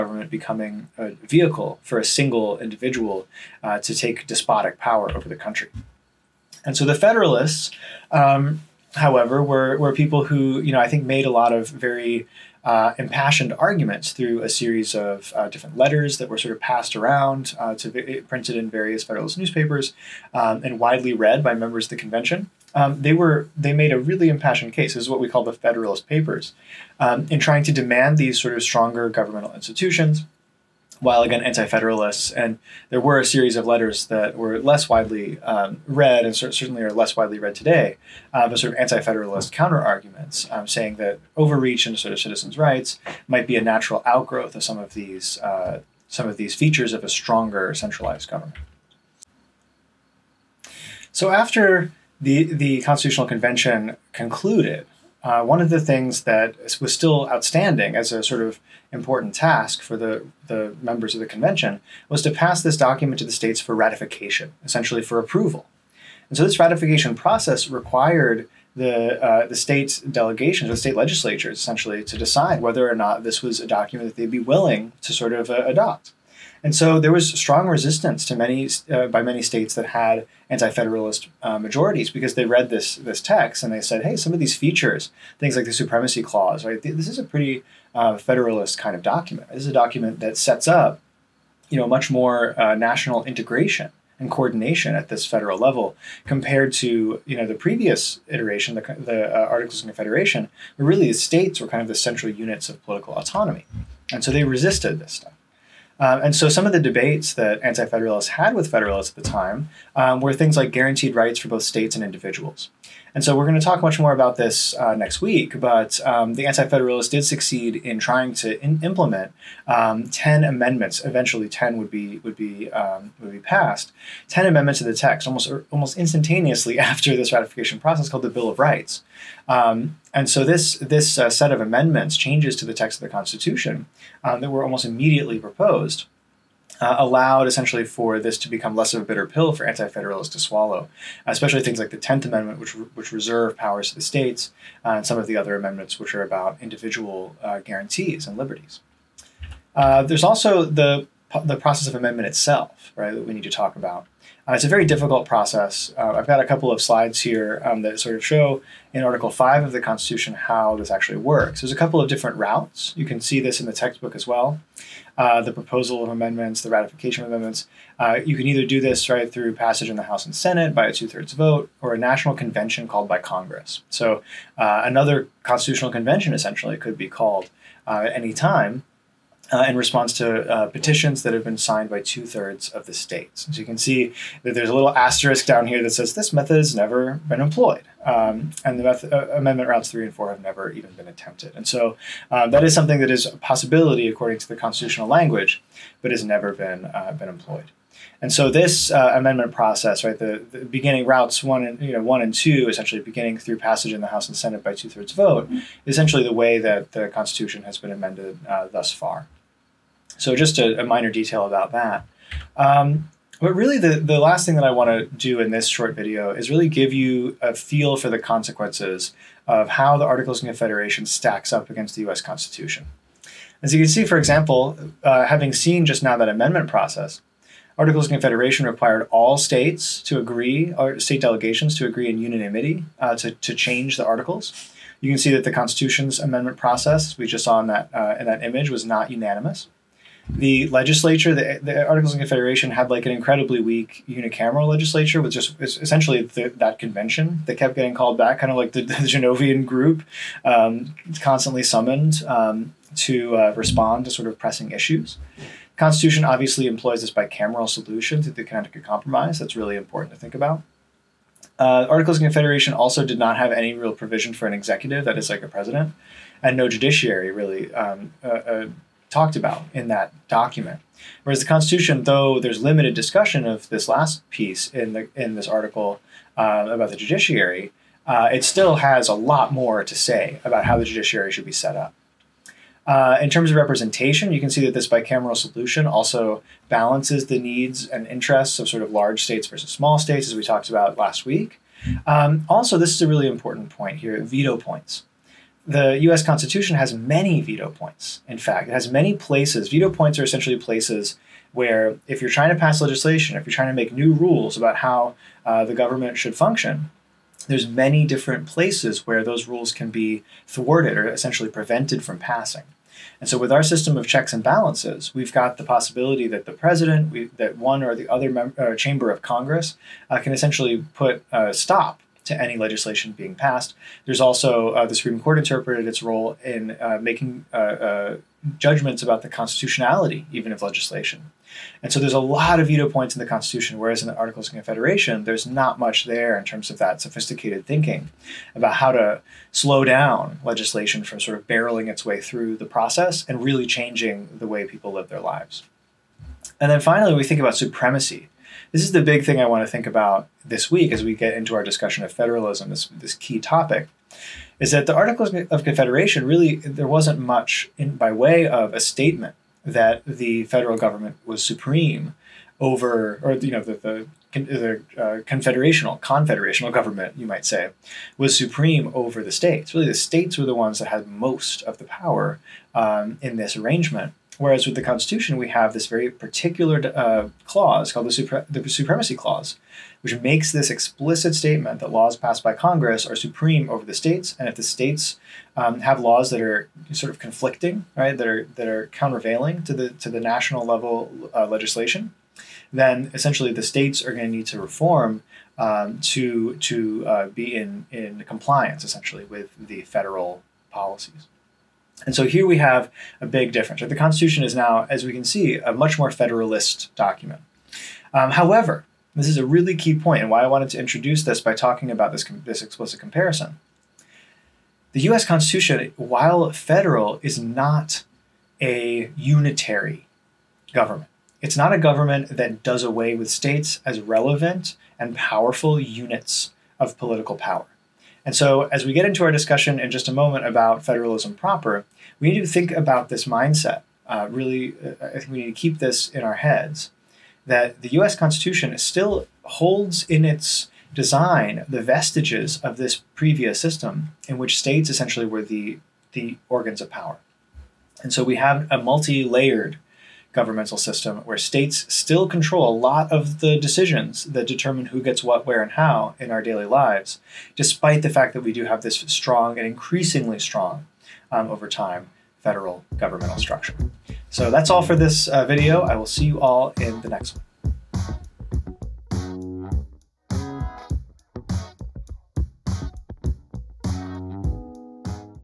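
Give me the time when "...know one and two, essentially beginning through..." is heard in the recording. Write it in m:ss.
3:21.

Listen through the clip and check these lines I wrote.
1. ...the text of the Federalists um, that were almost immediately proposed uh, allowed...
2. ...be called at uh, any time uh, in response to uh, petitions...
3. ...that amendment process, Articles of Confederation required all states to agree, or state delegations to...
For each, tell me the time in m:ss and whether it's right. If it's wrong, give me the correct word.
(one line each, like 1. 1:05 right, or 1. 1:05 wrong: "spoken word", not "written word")
1. 2:12 wrong: "Constitution", not "Federalists"
2. 2:56 right
3. 3:46 right.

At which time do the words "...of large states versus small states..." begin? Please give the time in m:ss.
4:48.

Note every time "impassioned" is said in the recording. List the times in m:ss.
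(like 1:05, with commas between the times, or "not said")
0:12, 0:24.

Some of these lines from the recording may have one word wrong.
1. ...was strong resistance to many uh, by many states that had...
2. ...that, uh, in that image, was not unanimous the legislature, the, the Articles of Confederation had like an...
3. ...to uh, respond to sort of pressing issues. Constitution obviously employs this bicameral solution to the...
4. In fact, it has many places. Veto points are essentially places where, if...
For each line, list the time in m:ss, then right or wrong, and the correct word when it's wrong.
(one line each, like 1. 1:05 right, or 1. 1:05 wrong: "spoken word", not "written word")
1. 1:17 right
2. 3:57 right
3. 4:12 right
4. 4:58 right.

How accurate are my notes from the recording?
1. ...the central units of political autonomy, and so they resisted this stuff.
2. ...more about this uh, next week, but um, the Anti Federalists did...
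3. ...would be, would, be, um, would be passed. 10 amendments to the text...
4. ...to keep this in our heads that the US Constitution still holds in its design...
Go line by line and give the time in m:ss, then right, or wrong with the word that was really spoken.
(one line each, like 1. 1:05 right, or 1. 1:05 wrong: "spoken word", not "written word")
1. 1:41 right
2. 1:53 right
3. 2:01 right
4. 7:15 right.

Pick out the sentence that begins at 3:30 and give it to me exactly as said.
So just a, a minor detail about that.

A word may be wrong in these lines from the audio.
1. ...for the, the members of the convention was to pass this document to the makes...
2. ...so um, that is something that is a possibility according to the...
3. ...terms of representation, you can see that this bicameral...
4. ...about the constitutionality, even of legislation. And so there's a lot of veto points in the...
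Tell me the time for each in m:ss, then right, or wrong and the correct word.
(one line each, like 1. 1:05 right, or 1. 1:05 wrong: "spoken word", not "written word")
1. 0:59 wrong: "states", not "makes"
2. 3:11 right
3. 4:43 right
4. 5:29 right.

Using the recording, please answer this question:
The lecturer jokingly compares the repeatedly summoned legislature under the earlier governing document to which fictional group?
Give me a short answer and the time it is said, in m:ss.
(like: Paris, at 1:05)
the Genovian group, at 4:08.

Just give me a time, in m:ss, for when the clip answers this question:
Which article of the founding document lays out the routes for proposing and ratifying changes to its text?
2:39.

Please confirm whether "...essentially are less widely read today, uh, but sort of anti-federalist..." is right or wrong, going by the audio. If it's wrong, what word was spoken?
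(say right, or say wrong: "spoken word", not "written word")
wrong: "certainly", not "essentially".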